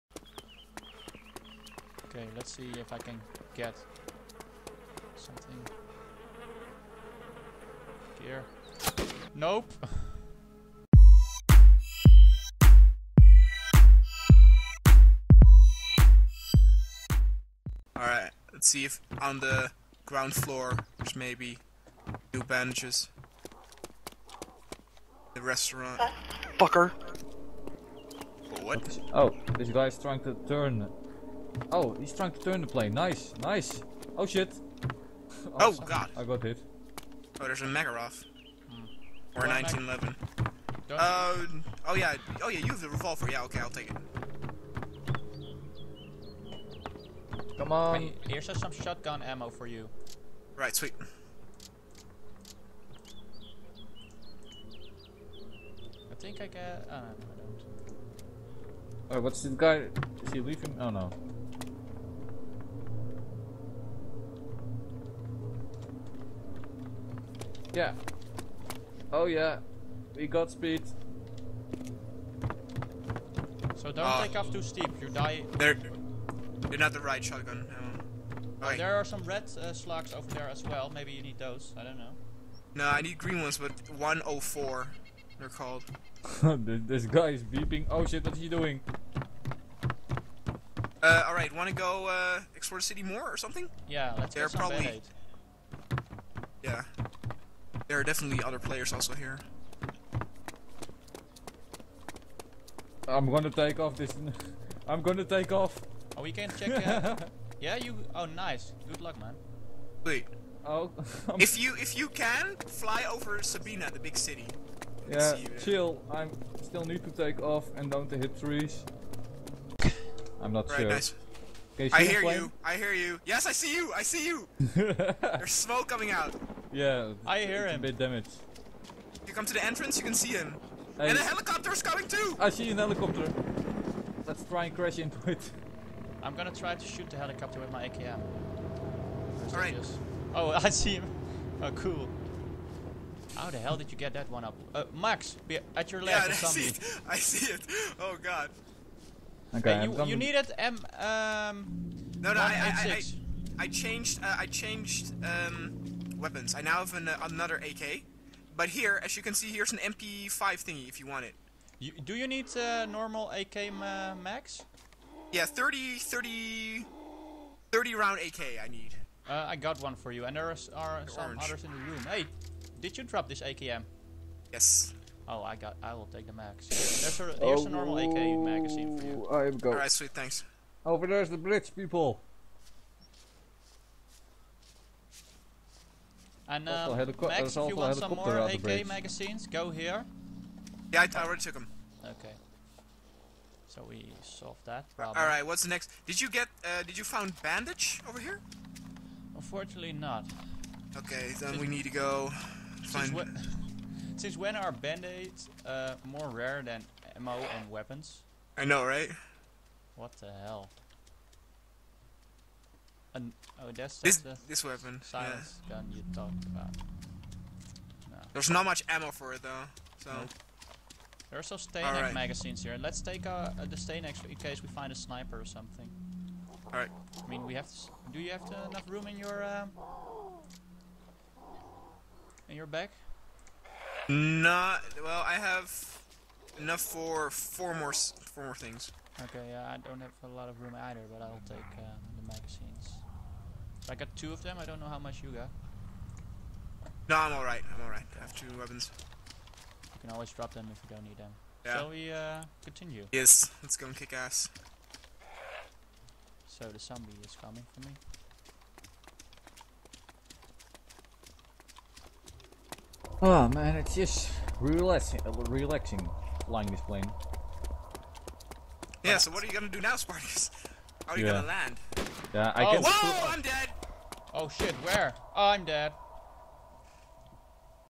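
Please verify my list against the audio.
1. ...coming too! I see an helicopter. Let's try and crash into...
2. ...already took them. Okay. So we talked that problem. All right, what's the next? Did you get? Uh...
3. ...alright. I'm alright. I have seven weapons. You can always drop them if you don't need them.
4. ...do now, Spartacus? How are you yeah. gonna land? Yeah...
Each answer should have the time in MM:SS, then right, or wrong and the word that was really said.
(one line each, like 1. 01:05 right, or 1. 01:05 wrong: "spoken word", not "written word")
1. 02:11 right
2. 03:11 wrong: "solved", not "talked"
3. 04:07 wrong: "two", not "seven"
4. 04:29 right.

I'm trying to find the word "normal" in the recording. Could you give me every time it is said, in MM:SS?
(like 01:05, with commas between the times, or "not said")
02:42, 02:57.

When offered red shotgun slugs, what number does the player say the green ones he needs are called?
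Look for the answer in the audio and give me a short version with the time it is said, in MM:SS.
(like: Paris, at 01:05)
104, at 01:23.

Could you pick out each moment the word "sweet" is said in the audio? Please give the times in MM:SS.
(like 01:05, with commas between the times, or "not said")
00:50, 02:59.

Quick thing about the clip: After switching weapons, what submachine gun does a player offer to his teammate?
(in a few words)
MP5.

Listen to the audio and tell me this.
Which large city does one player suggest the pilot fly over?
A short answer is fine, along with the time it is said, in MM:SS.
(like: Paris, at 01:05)
Sabina, at 01:53.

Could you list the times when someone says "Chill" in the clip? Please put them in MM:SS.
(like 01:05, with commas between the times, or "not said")
01:55.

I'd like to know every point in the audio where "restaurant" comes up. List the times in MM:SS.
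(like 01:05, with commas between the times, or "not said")
00:25.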